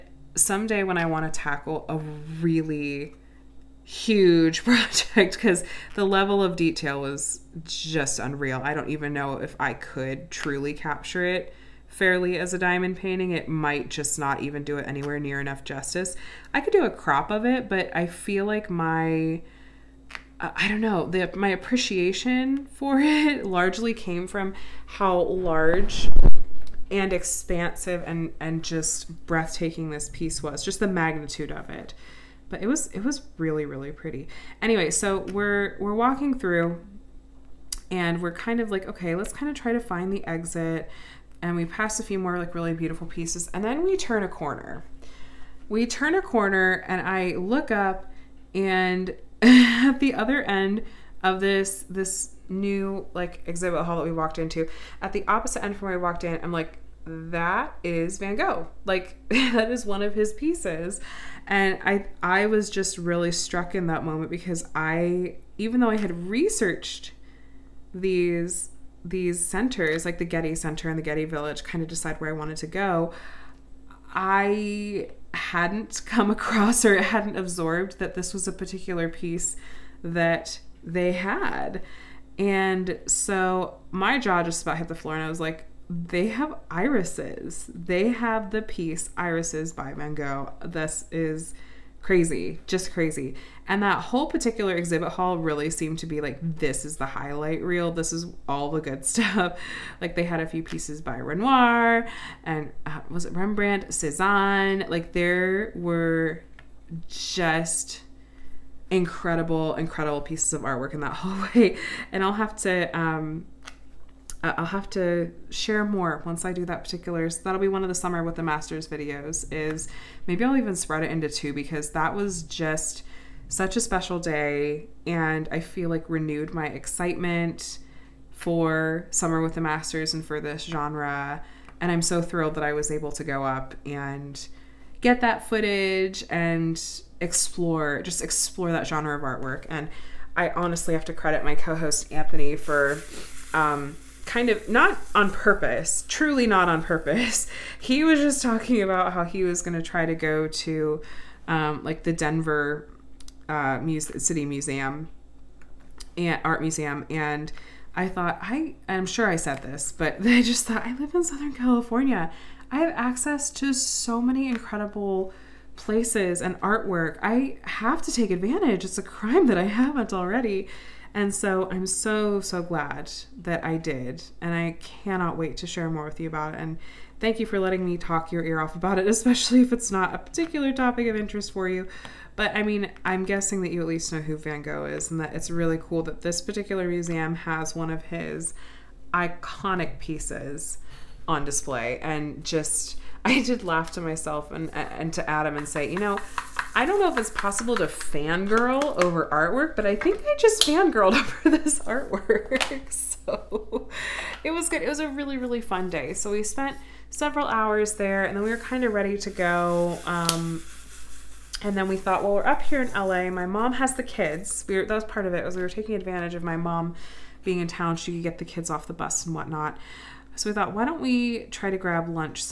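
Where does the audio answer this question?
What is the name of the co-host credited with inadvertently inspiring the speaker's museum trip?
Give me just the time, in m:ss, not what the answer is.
2:22.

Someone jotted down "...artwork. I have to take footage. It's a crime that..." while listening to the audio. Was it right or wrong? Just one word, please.
wrong.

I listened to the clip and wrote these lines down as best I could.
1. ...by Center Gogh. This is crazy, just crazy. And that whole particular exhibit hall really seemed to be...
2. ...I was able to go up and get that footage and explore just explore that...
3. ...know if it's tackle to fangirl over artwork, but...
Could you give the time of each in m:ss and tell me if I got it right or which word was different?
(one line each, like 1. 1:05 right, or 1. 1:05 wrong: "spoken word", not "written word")
1. 1:29 wrong: "Van", not "Center"
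2. 2:12 right
3. 3:16 wrong: "possible", not "tackle".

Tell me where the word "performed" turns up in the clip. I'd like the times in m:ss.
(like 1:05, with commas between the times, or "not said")
not said.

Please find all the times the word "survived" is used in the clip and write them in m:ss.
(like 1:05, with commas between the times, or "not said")
not said.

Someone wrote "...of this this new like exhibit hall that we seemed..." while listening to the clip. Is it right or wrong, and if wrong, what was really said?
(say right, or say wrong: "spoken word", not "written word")
wrong: "walked", not "seemed".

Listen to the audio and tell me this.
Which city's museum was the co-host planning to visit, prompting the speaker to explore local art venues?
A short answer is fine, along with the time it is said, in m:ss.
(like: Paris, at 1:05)
Denver, at 2:32.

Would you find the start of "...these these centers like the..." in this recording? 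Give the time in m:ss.
1:07.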